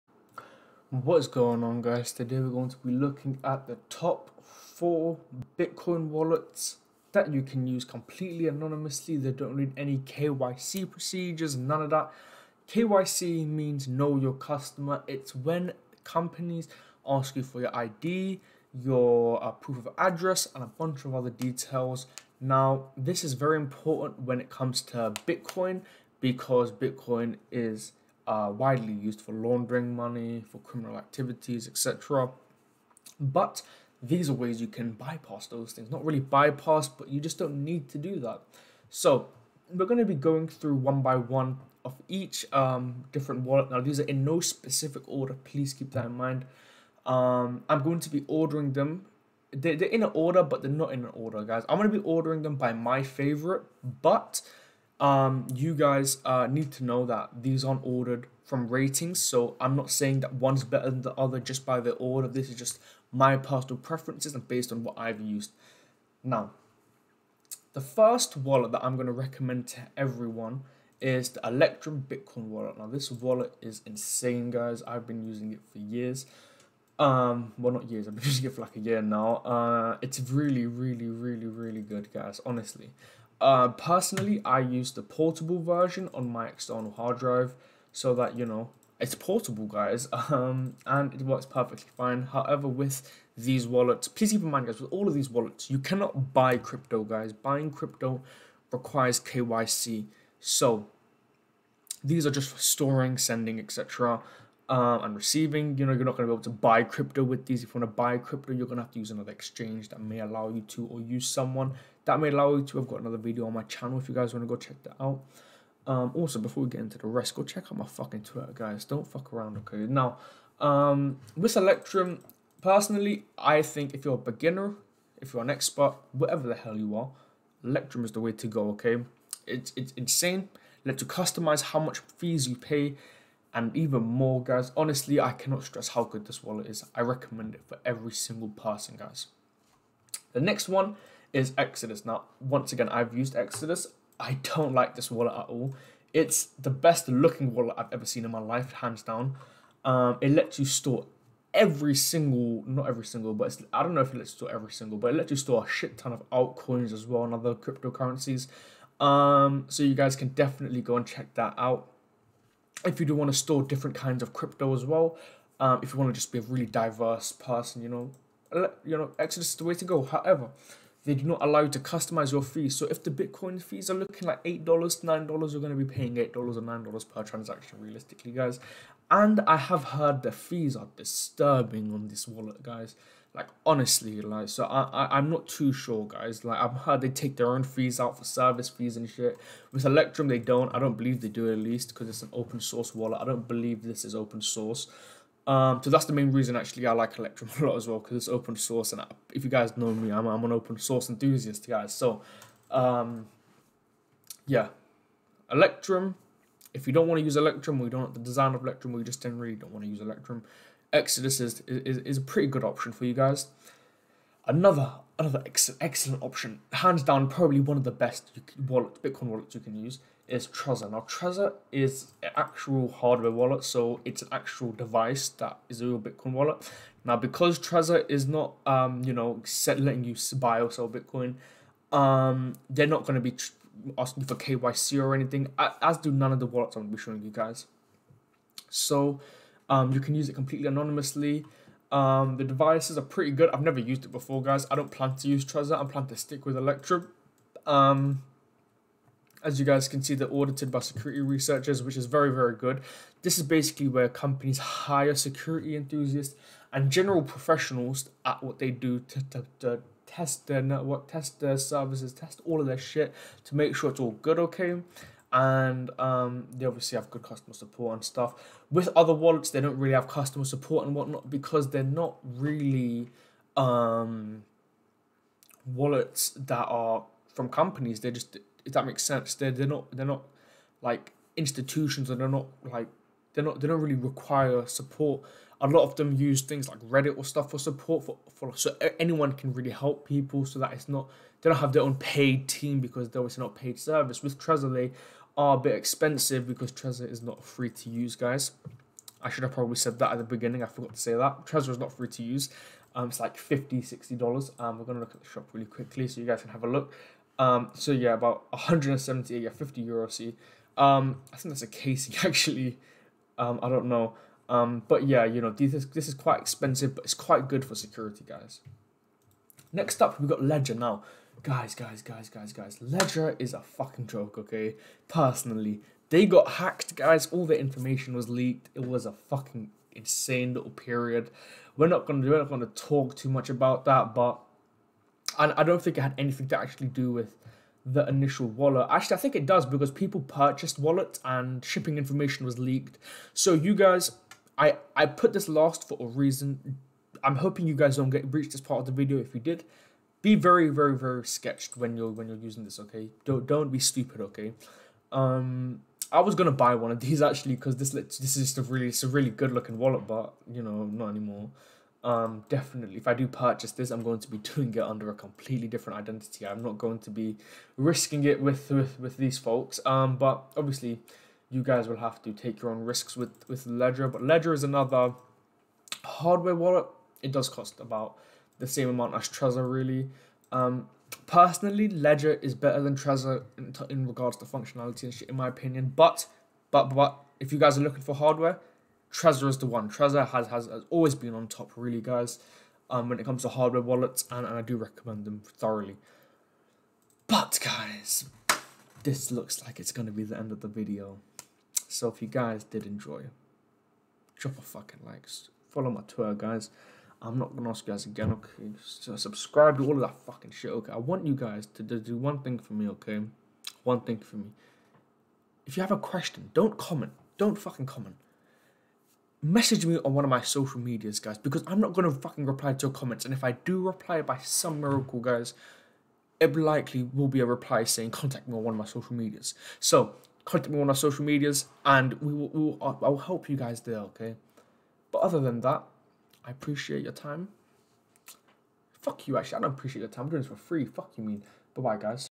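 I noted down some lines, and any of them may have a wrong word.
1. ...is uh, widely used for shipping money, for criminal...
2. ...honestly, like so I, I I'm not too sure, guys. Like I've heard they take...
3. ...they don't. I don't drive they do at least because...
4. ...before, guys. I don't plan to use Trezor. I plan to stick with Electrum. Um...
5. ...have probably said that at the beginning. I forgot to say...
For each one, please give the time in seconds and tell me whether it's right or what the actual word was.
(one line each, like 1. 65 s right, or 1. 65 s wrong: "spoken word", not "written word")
1. 27 s wrong: "laundering", not "shipping"
2. 183 s right
3. 190 s wrong: "believe", not "drive"
4. 244 s right
5. 299 s right.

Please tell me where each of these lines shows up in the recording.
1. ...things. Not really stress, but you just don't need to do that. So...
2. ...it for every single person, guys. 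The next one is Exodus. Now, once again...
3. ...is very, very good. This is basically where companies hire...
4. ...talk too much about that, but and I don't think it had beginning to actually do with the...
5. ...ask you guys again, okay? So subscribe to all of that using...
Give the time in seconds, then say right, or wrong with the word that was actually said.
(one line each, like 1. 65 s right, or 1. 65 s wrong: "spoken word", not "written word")
1. 35 s wrong: "bypass", not "stress"
2. 137 s right
3. 251 s right
4. 332 s wrong: "anything", not "beginning"
5. 407 s wrong: "fucking", not "using".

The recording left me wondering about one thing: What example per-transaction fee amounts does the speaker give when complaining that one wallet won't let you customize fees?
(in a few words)
$8 or $9.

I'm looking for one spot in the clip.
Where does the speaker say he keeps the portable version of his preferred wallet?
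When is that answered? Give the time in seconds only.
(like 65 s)
86 s.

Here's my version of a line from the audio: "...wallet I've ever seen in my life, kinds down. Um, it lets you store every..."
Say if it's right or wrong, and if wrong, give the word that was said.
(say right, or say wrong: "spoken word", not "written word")
wrong: "hands", not "kinds".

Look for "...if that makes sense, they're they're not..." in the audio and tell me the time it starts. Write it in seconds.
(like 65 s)
278 s.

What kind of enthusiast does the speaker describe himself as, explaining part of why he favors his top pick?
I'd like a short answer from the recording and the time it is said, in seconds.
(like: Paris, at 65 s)
Open source enthusiast, at 200 s.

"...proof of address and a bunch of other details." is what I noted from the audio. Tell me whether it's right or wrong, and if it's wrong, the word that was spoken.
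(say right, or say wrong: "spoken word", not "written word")
right.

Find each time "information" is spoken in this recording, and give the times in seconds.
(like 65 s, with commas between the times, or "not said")
327 s, 341 s.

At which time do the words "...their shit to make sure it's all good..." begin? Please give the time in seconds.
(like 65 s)
262 s.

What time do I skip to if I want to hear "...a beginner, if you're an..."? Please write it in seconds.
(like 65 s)
124 s.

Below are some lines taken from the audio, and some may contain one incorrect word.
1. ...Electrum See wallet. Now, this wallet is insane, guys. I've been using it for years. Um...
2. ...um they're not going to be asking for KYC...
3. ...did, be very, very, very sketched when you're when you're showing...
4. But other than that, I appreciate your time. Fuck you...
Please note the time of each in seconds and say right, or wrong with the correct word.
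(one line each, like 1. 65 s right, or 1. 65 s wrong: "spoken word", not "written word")
1. 71 s wrong: "Bitcoin", not "See"
2. 231 s right
3. 349 s wrong: "using", not "showing"
4. 435 s right.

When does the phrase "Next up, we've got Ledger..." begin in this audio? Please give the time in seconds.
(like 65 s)
319 s.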